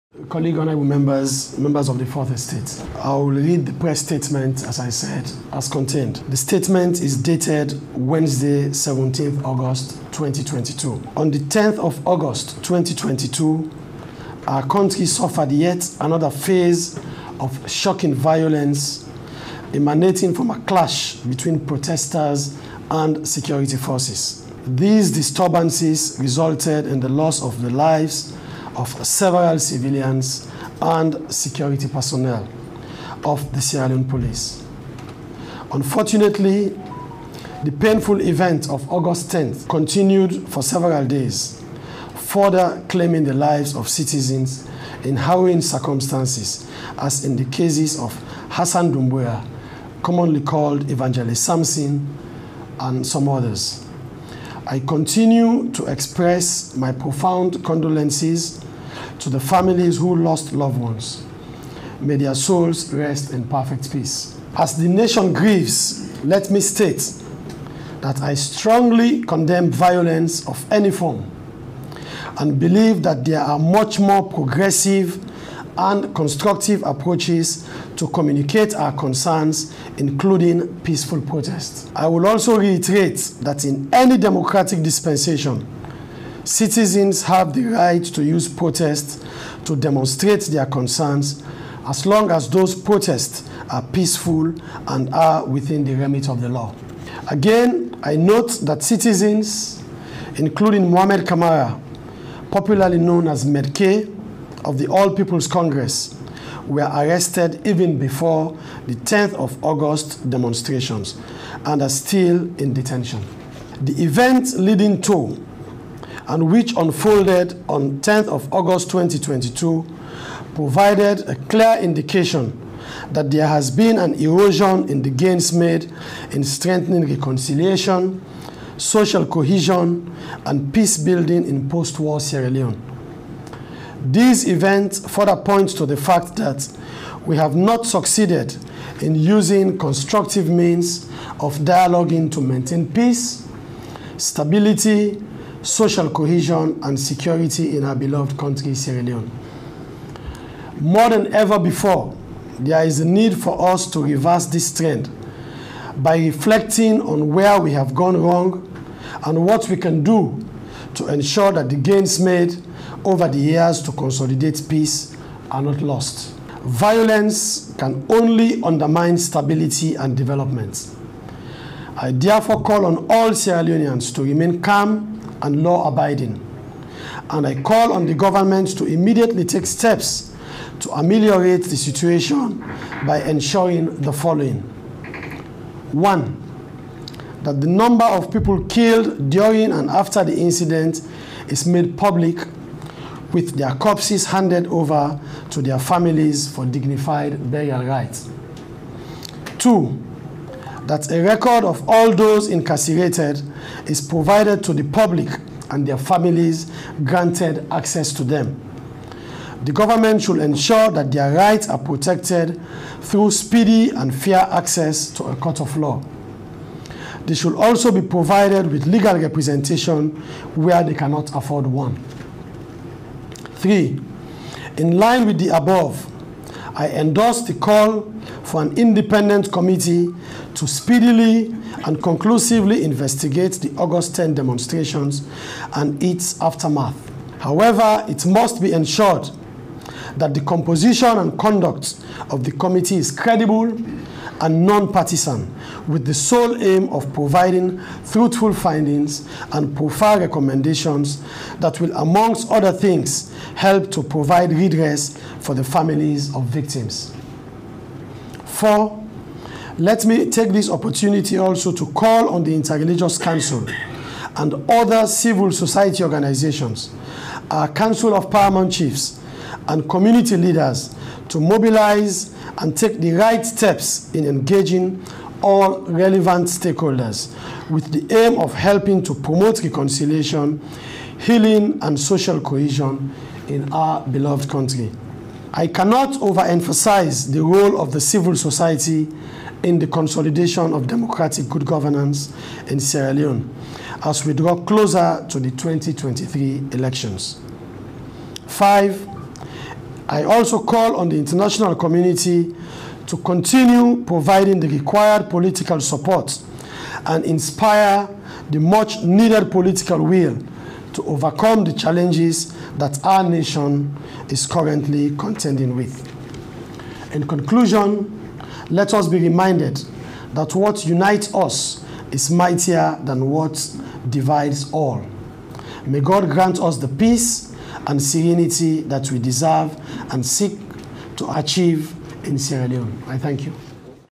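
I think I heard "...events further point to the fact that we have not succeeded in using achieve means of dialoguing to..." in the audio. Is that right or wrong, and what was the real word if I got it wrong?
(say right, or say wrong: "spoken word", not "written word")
wrong: "constructive", not "achieve".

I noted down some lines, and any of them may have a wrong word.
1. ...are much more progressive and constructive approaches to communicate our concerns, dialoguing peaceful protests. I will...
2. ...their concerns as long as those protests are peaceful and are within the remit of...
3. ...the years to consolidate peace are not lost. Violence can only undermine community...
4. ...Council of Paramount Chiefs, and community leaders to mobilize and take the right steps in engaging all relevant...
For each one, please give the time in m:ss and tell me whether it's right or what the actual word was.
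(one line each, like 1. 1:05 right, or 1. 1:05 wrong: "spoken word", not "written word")
1. 1:13 wrong: "including", not "dialoguing"
2. 1:30 right
3. 2:43 wrong: "stability", not "community"
4. 4:27 right.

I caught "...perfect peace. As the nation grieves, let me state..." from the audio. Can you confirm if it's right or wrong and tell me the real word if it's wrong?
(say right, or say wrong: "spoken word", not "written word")
right.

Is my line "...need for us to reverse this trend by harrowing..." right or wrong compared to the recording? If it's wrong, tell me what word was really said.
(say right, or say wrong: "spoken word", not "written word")
wrong: "reflecting", not "harrowing".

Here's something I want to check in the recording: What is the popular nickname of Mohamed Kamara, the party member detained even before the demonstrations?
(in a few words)
Medke.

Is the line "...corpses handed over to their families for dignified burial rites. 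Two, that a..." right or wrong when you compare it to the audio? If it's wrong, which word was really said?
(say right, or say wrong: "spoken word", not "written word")
right.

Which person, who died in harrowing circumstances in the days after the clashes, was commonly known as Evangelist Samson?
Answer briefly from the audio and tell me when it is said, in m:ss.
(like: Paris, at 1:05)
Hassan Dumbuya, at 0:48.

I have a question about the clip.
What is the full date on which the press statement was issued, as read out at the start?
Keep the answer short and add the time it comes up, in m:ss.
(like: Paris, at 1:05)
Wednesday, 17 August 2022, at 0:07.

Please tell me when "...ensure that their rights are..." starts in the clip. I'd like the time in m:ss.
3:30.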